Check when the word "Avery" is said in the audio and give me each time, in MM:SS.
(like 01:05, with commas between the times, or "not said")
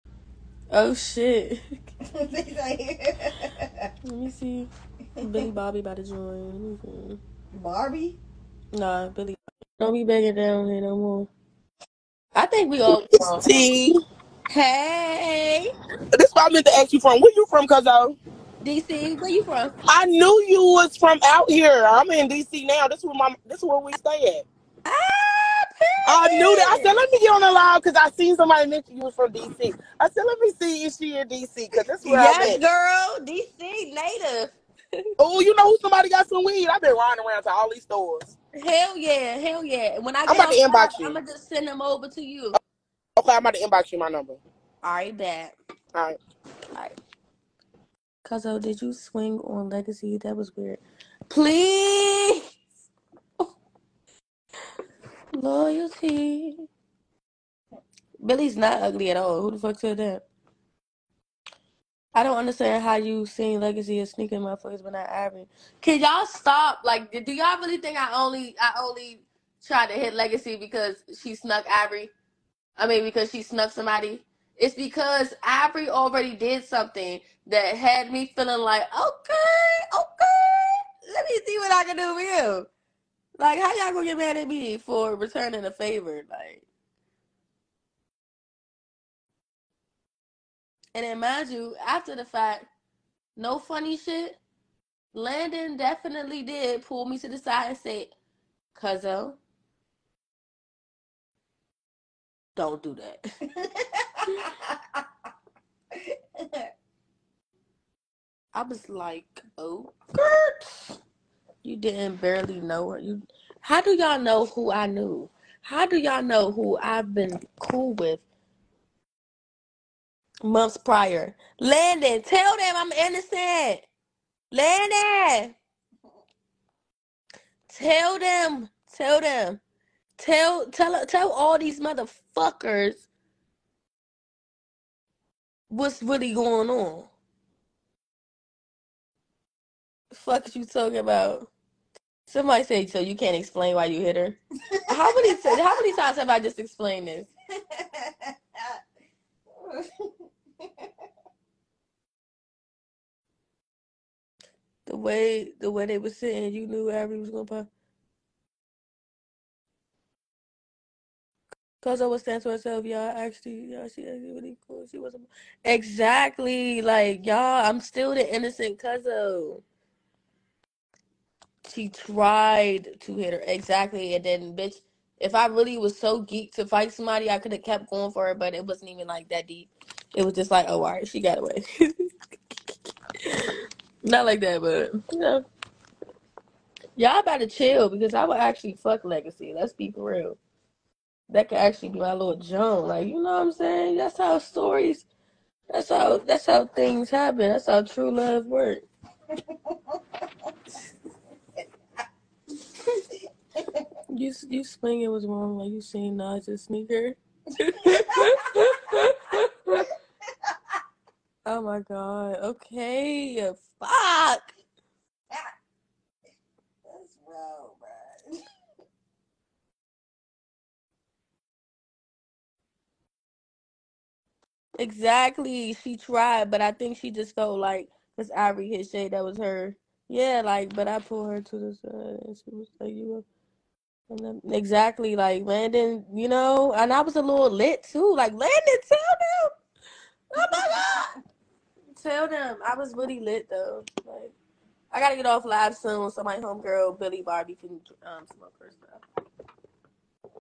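02:36.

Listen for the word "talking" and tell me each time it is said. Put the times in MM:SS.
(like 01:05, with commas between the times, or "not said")
02:20.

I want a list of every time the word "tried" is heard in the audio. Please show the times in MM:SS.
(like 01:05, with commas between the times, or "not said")
01:09, 02:51, 03:45.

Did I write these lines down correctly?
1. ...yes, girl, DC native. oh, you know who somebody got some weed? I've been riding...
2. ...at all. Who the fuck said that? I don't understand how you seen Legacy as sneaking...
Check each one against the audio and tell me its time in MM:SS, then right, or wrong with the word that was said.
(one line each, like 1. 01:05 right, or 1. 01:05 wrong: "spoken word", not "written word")
1. 00:32 right
2. 00:59 right.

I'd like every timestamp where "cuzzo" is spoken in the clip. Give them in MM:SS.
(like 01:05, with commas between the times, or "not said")
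00:17, 00:48, 01:38, 02:48.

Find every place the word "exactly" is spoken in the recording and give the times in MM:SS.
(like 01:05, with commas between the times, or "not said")
02:45, 02:53, 03:44, 03:54.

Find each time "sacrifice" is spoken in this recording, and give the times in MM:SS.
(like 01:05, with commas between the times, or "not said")
not said.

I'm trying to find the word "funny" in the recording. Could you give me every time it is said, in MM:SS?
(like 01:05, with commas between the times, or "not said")
01:33.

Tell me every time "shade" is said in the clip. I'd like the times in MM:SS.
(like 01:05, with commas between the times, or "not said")
03:48.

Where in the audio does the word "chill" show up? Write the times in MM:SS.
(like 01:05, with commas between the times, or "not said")
03:07.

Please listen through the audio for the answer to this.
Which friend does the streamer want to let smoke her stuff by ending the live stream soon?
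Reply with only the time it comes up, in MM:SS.
04:06.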